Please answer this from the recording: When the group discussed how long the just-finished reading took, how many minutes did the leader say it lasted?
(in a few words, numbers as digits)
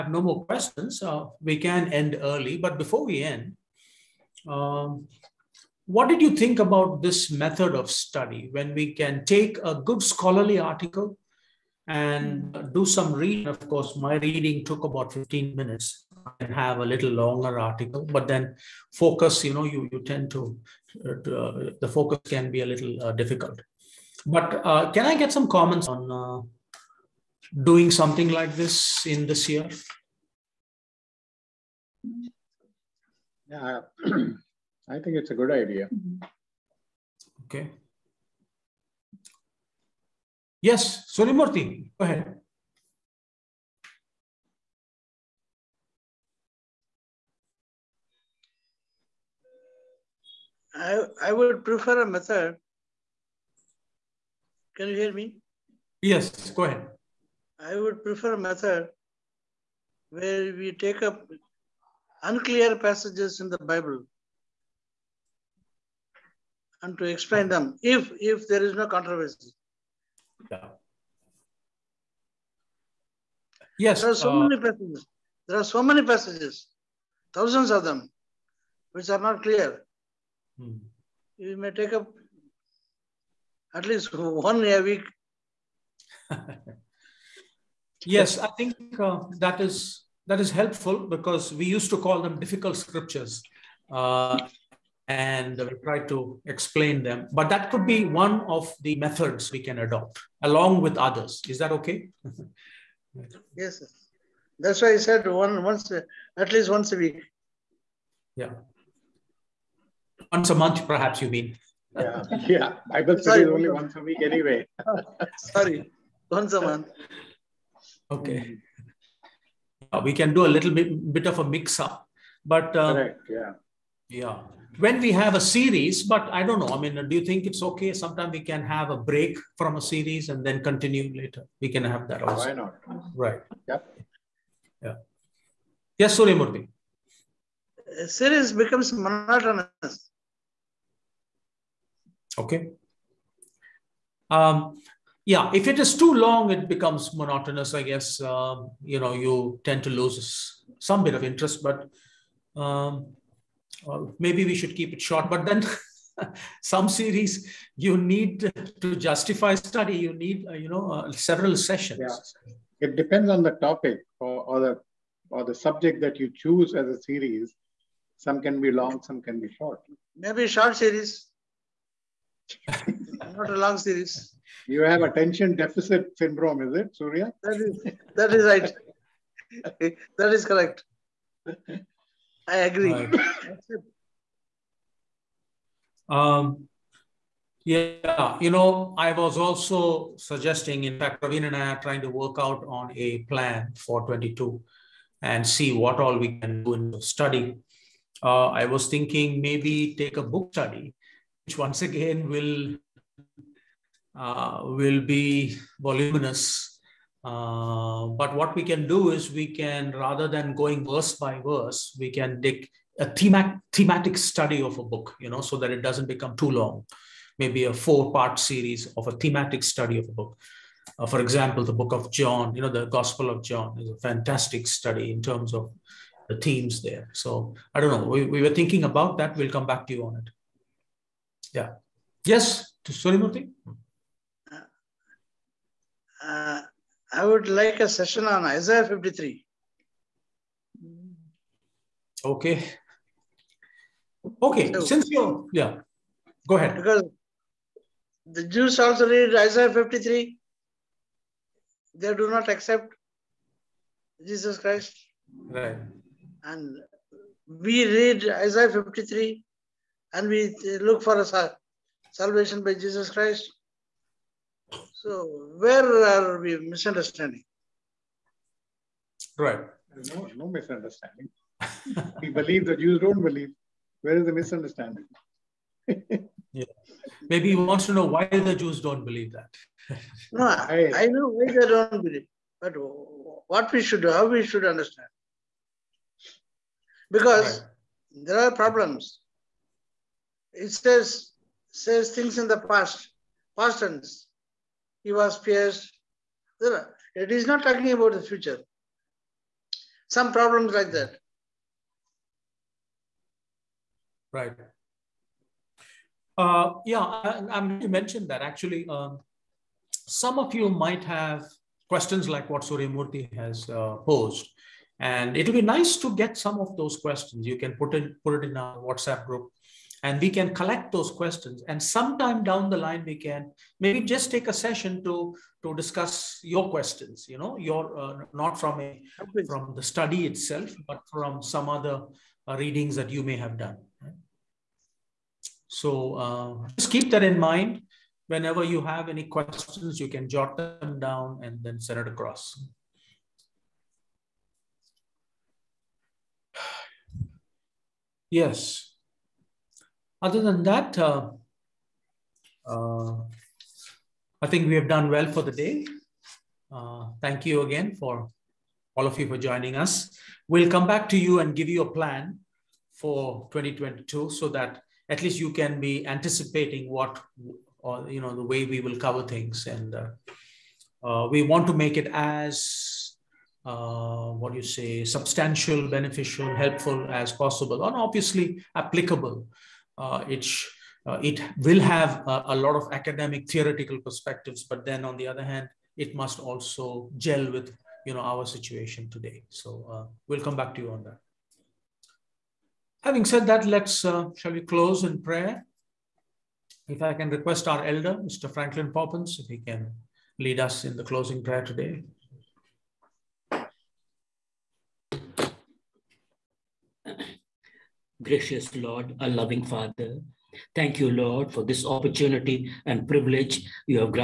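15.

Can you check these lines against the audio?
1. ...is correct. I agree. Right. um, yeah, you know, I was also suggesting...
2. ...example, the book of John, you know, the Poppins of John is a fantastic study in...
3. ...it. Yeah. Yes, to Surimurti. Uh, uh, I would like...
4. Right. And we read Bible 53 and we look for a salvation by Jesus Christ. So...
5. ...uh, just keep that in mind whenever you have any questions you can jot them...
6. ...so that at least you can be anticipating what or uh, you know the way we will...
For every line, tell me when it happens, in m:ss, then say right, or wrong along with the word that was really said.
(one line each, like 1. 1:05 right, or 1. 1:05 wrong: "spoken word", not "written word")
1. 3:00 right
2. 3:41 wrong: "Gospel", not "Poppins"
3. 3:50 right
4. 4:15 wrong: "Isaiah", not "Bible"
5. 5:36 right
6. 6:04 right.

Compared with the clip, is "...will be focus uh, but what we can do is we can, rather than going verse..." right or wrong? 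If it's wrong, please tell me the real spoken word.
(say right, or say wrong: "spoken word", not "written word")
wrong: "voluminous", not "focus".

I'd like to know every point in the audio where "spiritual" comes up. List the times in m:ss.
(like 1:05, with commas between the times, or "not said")
not said.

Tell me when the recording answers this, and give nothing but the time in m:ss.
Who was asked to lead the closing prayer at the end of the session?
6:38.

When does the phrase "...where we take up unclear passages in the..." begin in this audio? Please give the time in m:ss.
1:00.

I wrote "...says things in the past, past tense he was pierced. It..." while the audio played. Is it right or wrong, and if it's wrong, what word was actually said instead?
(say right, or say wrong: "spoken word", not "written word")
right.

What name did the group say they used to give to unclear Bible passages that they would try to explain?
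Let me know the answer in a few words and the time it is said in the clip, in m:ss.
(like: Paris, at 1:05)
difficult scriptures, at 1:32.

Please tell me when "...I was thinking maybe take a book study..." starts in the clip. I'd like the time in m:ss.
3:18.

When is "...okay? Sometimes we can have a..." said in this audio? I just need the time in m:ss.
2:07.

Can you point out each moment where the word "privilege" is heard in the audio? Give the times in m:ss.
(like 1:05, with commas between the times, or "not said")
6:53.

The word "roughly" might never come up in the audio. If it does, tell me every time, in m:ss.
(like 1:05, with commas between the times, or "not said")
not said.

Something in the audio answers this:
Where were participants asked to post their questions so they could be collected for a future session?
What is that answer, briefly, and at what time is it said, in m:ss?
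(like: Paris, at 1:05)
WhatsApp group, at 5:18.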